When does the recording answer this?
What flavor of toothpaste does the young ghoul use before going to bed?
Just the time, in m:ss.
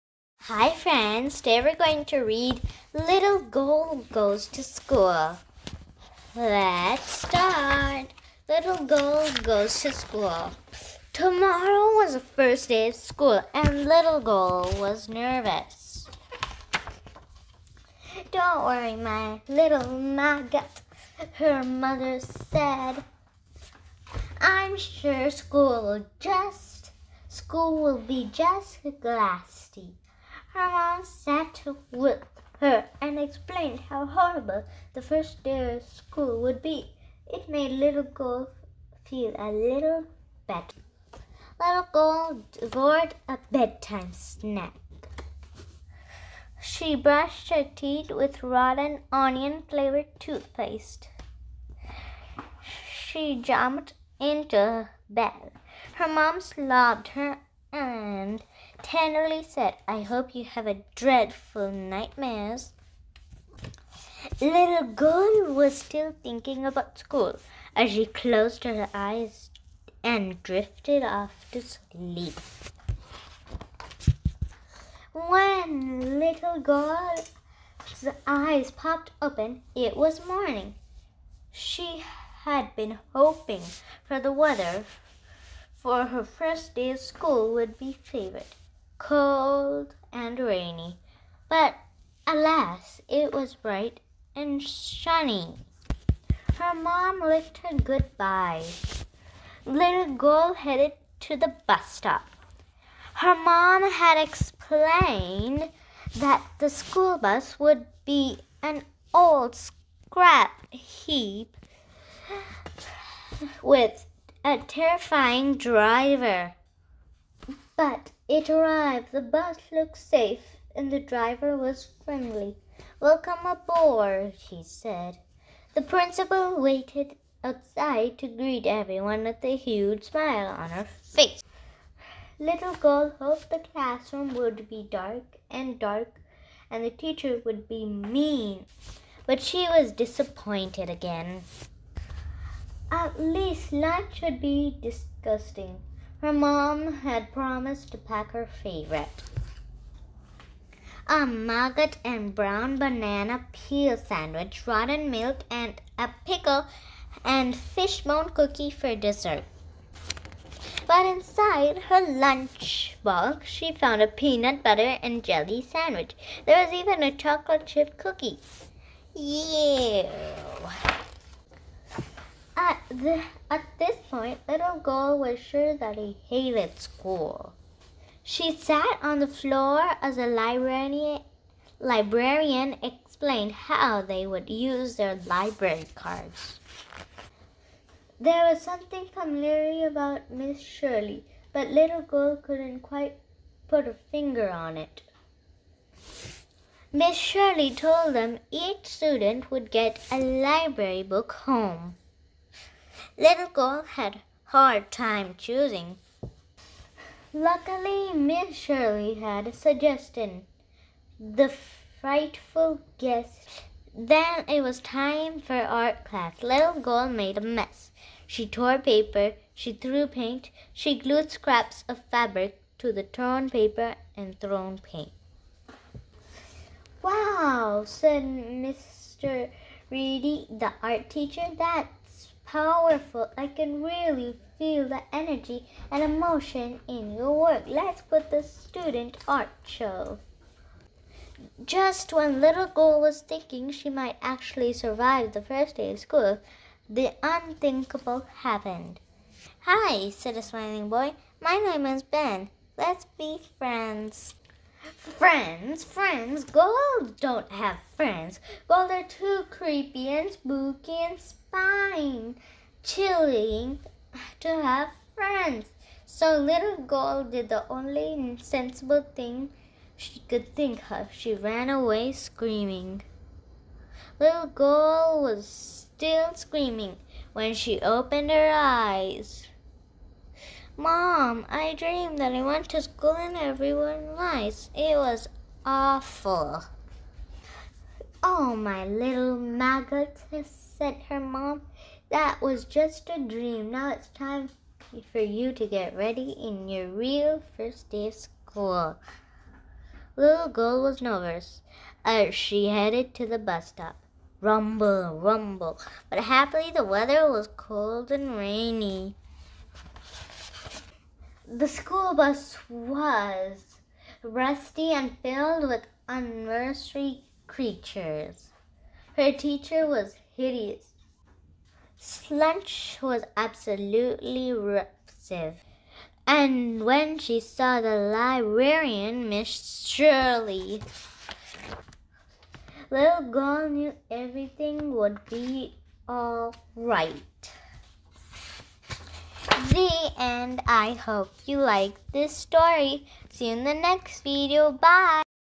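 0:48.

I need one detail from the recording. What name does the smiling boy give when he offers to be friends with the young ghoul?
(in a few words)
Ben.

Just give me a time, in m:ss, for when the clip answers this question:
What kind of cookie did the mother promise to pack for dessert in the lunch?
2:36.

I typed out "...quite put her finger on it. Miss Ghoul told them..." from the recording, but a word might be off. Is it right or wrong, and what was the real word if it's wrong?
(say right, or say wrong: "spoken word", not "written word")
wrong: "Shirley", not "Ghoul".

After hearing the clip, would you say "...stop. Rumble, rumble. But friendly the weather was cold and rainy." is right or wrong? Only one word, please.
wrong.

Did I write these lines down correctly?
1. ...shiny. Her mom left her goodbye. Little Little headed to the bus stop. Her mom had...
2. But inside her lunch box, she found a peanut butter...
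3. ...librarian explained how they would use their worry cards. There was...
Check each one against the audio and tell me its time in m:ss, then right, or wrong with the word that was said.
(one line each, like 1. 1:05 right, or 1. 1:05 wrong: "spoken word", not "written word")
1. 1:34 wrong: "Ghoul", not "Little"
2. 2:40 right
3. 3:01 wrong: "library", not "worry".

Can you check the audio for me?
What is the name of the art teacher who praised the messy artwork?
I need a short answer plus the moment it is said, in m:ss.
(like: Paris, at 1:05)
Mr. Reedy, at 3:48.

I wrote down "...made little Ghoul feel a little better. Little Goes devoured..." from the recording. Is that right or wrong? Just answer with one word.
wrong.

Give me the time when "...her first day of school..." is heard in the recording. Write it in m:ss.
1:26.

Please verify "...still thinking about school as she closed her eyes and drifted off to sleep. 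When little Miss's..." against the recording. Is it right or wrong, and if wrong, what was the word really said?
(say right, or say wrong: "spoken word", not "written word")
wrong: "Ghoul", not "Miss".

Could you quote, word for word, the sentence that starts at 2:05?
The principal waited outside to greet everyone with a huge smile on her face.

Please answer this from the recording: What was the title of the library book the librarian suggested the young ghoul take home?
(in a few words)
The Frightful Guest.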